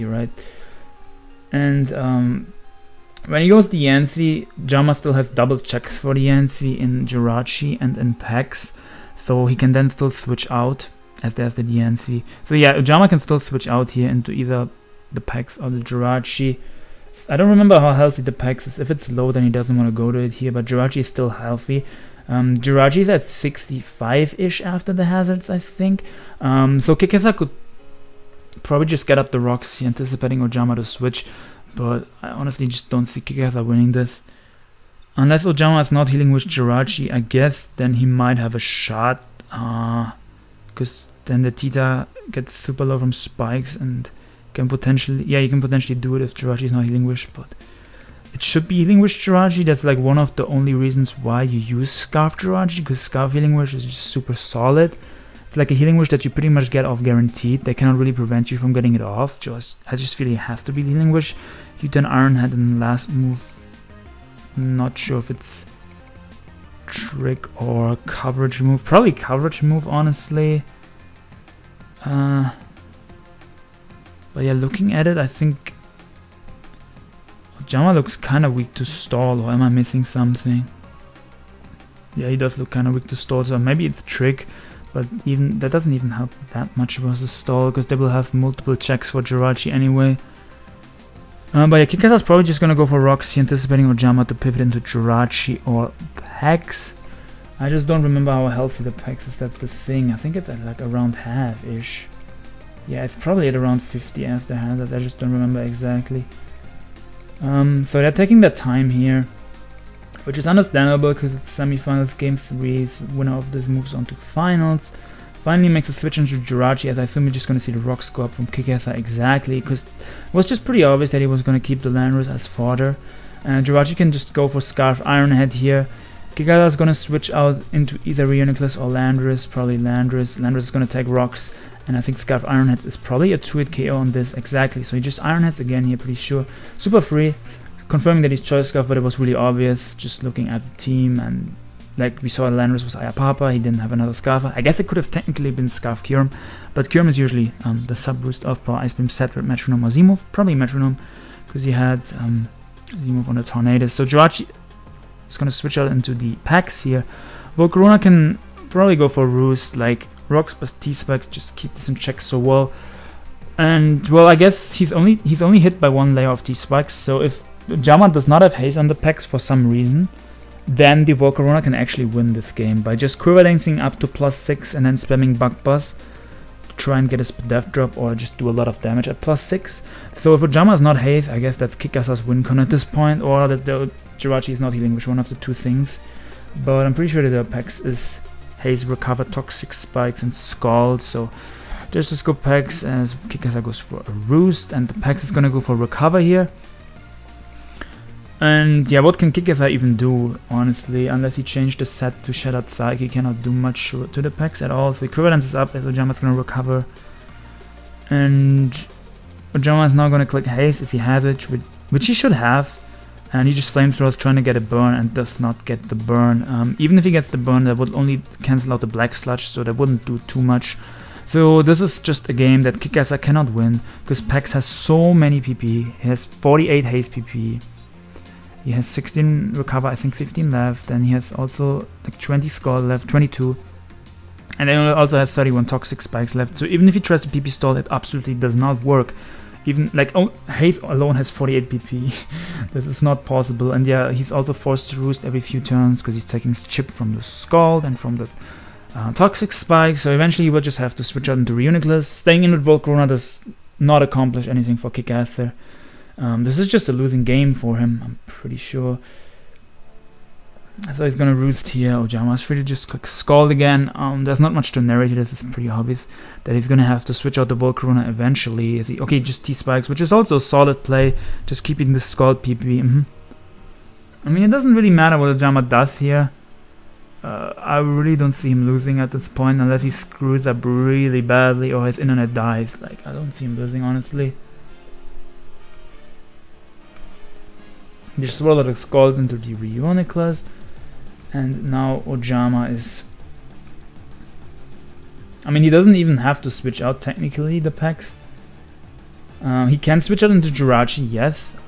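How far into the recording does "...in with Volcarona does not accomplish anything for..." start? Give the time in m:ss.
4:12.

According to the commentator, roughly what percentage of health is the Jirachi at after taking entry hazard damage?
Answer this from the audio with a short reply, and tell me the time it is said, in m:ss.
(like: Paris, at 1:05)
65, at 0:23.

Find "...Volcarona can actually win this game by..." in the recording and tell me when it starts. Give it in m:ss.
2:51.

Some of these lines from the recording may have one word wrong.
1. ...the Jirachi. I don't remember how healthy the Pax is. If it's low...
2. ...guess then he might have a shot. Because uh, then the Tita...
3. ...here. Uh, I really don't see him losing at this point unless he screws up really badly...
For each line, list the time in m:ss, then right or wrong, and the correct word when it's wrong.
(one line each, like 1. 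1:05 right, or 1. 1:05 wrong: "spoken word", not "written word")
1. 0:15 right
2. 0:37 right
3. 4:35 right.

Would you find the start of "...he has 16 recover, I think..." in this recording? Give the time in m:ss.
3:48.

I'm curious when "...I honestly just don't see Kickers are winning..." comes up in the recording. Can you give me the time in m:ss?
0:32.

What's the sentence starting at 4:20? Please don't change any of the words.
I thought he's going to roost here.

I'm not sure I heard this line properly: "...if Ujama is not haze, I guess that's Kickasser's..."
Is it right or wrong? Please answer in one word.
right.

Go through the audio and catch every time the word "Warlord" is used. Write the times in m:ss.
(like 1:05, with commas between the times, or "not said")
4:48.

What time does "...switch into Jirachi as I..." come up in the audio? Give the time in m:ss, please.
1:55.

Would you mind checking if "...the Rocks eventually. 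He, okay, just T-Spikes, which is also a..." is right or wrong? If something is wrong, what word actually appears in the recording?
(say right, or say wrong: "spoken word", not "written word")
wrong: "Volcarona", not "Rocks".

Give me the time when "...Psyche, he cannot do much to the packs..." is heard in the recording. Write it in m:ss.
3:22.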